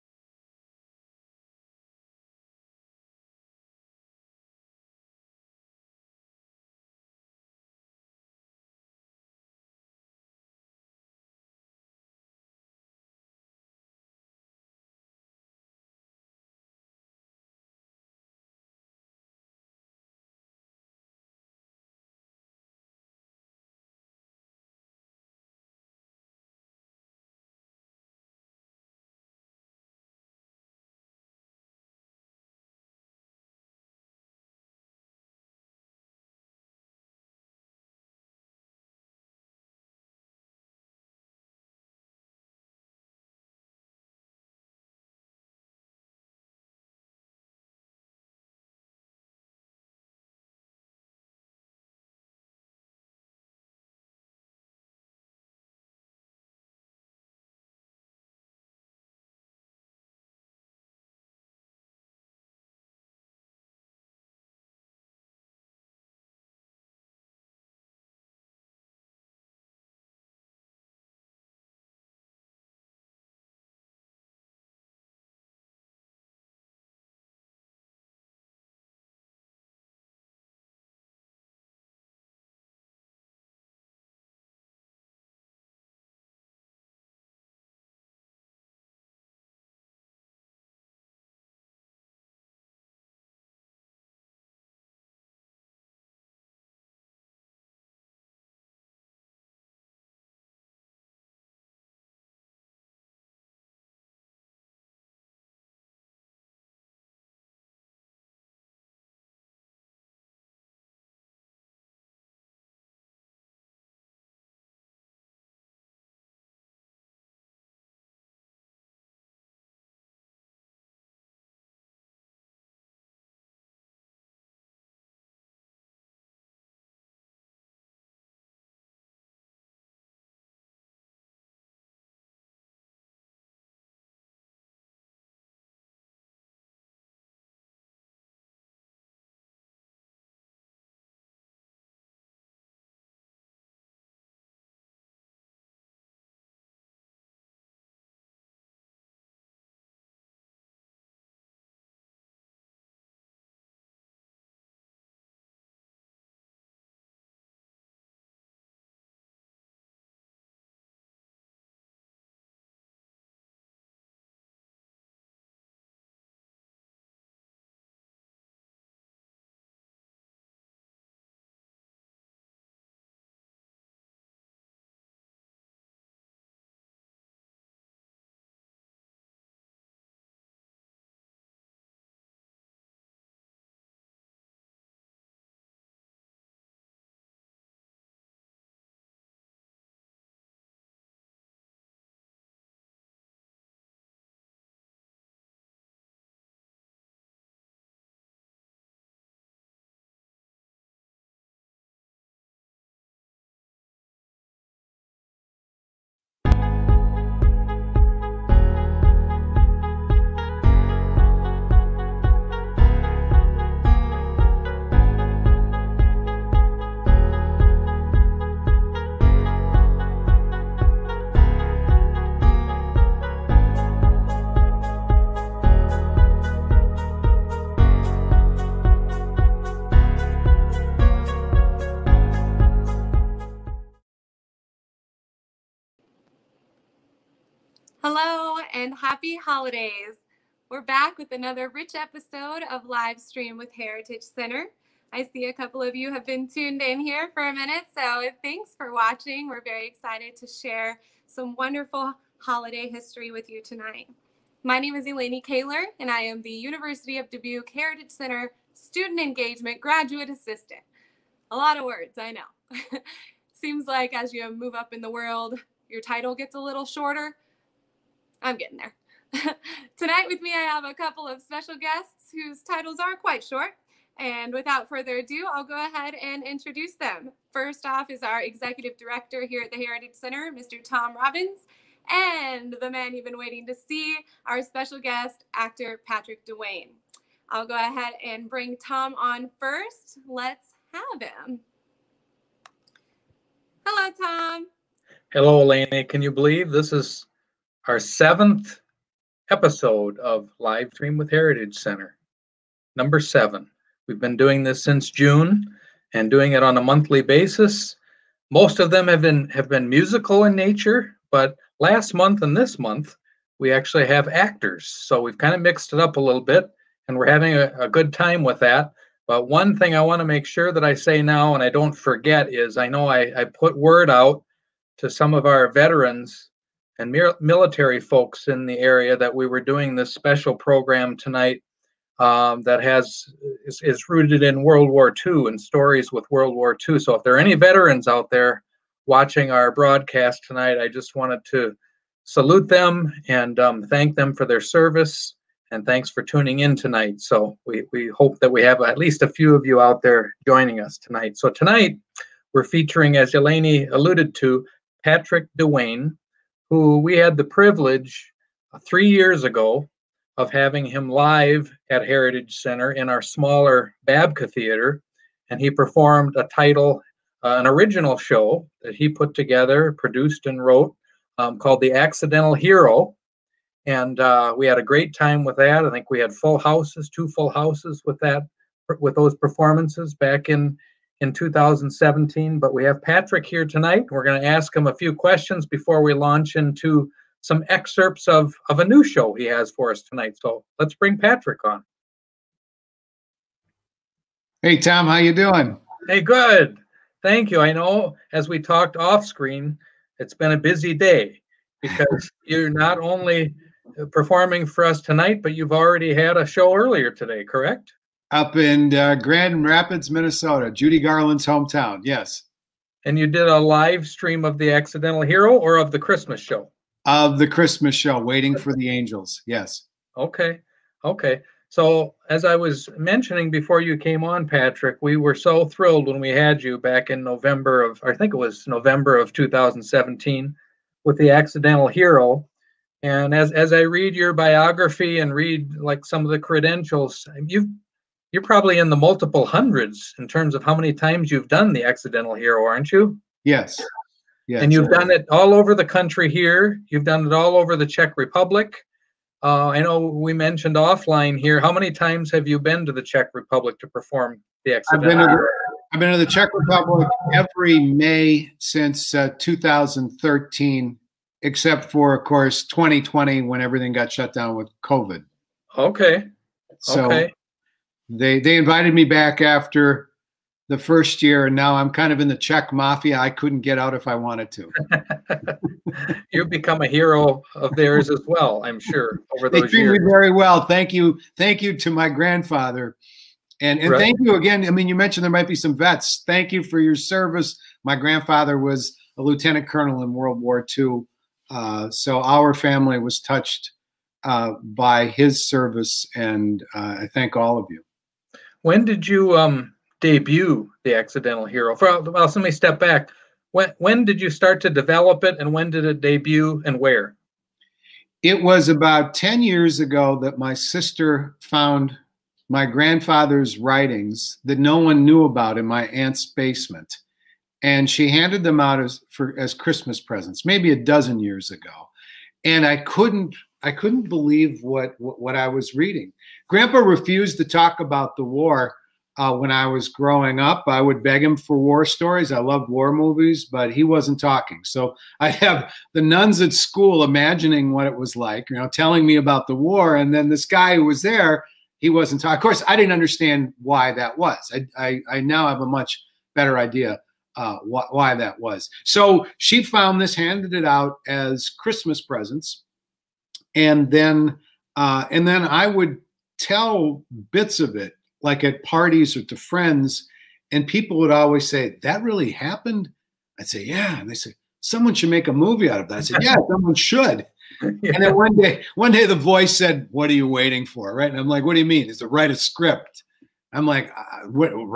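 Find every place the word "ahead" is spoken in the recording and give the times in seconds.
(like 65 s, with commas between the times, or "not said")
275 s, 287 s.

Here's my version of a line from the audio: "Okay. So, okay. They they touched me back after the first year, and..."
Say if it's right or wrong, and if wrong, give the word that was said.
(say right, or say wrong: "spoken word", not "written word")
wrong: "invited", not "touched".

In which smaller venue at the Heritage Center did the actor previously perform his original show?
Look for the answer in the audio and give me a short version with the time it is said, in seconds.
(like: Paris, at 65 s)
Babka Theater, at 364 s.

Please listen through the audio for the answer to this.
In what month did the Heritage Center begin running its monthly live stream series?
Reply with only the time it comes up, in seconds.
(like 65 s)
305 s.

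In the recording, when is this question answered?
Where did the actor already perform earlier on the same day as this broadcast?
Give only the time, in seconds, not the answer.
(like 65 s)
409 s.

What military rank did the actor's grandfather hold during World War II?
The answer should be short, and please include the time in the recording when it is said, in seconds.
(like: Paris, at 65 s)
lieutenant colonel, at 489 s.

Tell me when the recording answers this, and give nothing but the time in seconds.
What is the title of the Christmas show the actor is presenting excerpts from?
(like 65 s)
418 s.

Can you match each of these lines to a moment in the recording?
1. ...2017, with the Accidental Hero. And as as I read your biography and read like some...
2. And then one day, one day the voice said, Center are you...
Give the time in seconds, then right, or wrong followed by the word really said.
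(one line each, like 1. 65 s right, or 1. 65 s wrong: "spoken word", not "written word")
1. 429 s right
2. 567 s wrong: "What", not "Center".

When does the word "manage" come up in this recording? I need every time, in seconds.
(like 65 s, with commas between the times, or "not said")
not said.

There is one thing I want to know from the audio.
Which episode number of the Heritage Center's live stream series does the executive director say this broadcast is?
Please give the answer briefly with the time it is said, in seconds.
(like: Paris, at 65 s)
7, at 297 s.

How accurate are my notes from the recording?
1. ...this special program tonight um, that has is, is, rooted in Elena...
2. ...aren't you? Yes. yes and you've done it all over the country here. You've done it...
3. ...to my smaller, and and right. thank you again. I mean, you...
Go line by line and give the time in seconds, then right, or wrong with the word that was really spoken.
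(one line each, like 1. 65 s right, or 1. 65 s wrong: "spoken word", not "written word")
1. 329 s wrong: "World", not "Elena"
2. 442 s right
3. 481 s wrong: "grandfather", not "smaller".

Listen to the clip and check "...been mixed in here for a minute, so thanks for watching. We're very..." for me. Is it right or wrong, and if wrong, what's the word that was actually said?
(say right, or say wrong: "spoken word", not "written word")
wrong: "tuned", not "mixed".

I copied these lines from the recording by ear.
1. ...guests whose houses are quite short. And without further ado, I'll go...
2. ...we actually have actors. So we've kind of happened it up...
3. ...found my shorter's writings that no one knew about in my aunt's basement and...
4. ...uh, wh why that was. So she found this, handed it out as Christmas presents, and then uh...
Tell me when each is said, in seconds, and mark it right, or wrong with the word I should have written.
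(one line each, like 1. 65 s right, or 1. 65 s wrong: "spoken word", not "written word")
1. 271 s wrong: "titles", not "houses"
2. 313 s wrong: "mixed", not "happened"
3. 511 s wrong: "grandfather", not "shorter"
4. 547 s right.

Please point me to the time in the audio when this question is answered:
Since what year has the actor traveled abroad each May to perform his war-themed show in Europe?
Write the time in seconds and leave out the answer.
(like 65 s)
459 s.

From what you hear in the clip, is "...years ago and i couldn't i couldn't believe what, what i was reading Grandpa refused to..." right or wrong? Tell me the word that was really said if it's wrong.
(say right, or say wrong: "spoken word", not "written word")
right.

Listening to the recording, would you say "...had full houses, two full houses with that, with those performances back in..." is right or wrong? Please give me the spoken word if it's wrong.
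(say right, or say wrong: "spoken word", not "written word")
right.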